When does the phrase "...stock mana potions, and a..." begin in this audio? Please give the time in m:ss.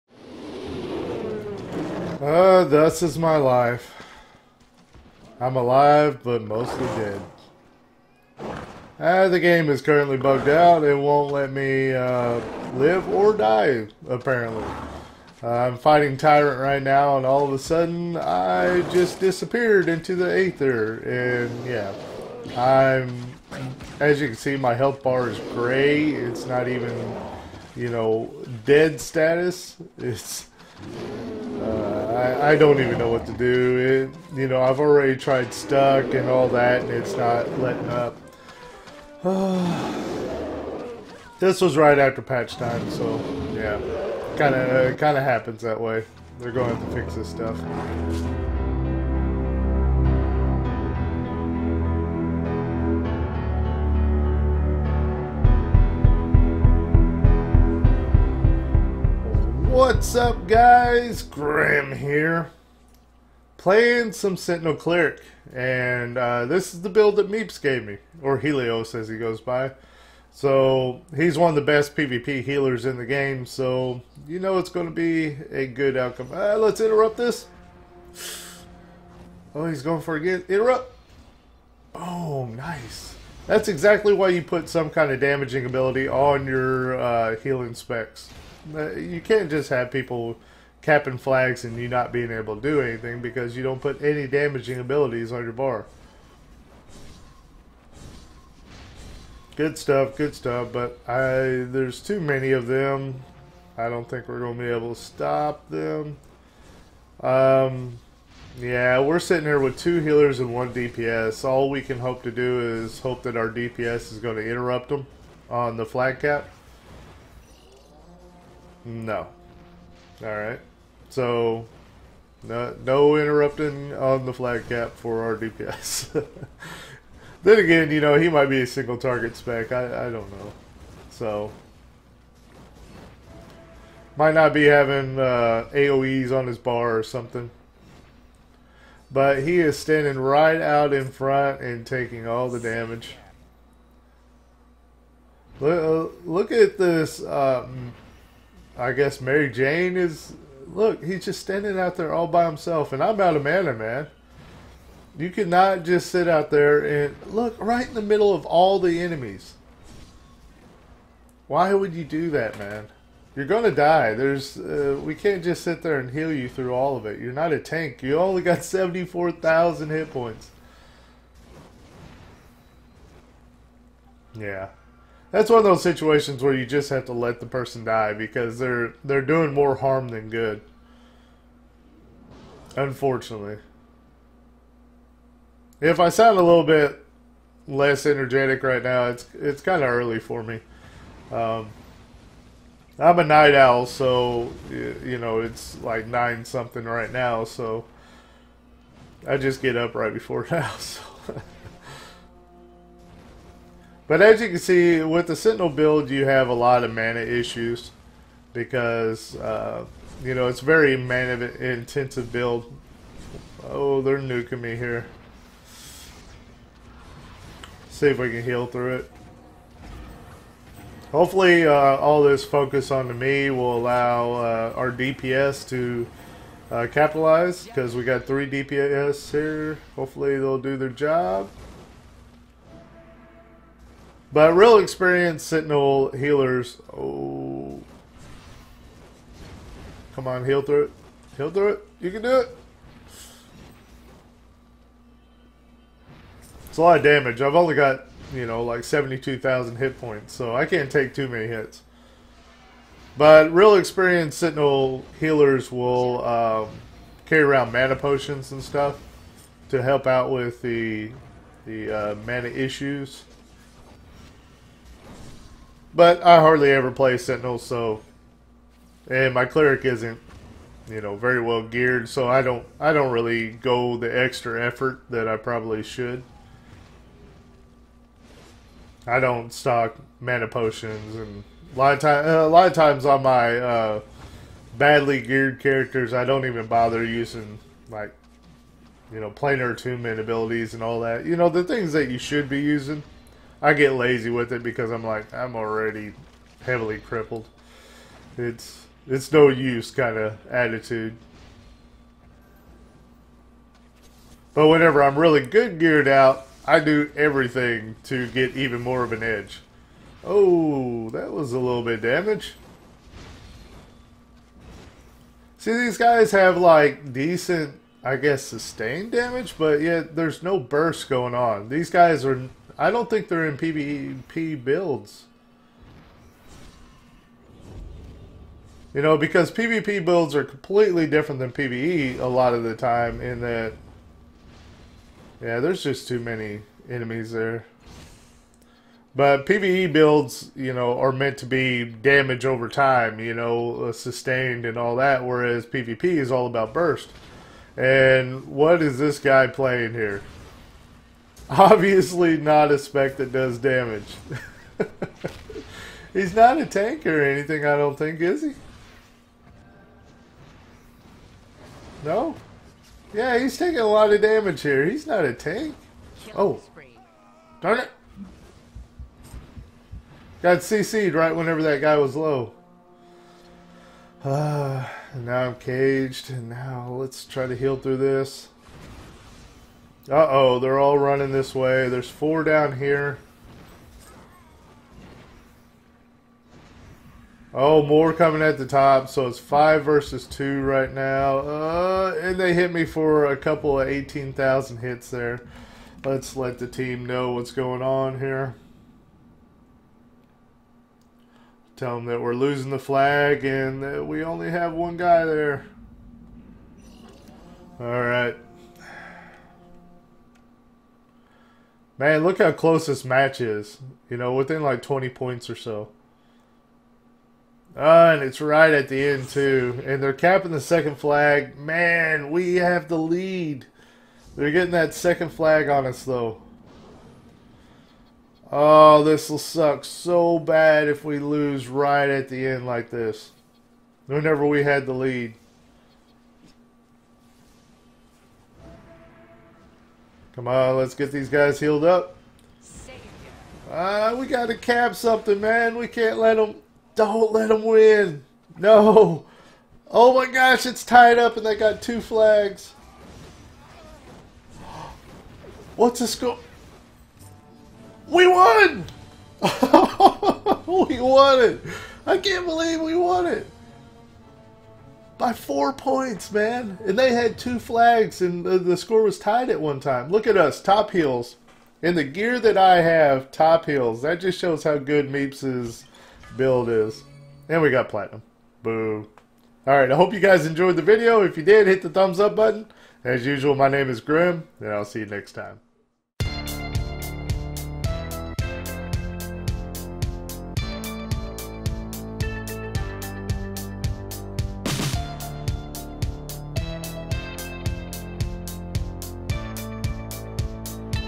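4:39.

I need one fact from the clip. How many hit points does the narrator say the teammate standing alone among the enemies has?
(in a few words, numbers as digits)
74,000.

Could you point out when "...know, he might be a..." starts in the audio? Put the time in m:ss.
2:08.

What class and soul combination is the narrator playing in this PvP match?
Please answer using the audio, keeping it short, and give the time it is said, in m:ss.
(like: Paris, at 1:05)
Sentinel Cleric, at 1:04.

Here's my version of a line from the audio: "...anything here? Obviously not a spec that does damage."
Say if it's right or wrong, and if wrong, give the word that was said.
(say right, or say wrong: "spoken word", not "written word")
wrong: "playing", not "anything".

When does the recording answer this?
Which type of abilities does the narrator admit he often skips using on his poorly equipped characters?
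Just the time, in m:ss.
4:49.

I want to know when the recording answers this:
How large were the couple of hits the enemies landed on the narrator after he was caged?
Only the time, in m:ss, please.
6:33.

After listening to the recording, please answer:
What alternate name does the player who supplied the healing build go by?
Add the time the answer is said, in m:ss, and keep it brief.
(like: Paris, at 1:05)
Helios, at 1:08.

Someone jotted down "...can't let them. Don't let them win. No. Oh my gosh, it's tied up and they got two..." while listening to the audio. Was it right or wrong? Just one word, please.
right.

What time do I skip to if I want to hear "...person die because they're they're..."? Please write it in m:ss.
2:57.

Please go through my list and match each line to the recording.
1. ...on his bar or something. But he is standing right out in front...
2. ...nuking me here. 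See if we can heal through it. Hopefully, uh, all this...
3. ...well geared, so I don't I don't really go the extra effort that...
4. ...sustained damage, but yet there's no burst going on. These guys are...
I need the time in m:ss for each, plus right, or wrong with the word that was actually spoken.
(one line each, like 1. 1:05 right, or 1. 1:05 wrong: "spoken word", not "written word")
1. 2:16 right
2. 3:34 right
3. 4:31 right
4. 5:18 right.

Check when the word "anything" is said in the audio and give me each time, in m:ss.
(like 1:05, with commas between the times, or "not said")
1:32, 5:57.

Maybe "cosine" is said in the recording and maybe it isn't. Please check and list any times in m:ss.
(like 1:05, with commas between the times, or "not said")
not said.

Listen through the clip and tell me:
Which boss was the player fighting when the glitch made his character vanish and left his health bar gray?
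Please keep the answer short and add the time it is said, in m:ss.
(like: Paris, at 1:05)
Tyrant, at 0:16.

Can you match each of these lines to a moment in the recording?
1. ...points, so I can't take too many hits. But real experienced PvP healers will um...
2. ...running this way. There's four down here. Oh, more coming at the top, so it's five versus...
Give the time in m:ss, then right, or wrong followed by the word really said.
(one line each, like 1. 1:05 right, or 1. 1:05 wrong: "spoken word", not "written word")
1. 4:09 wrong: "Sentinel", not "PvP"
2. 6:20 right.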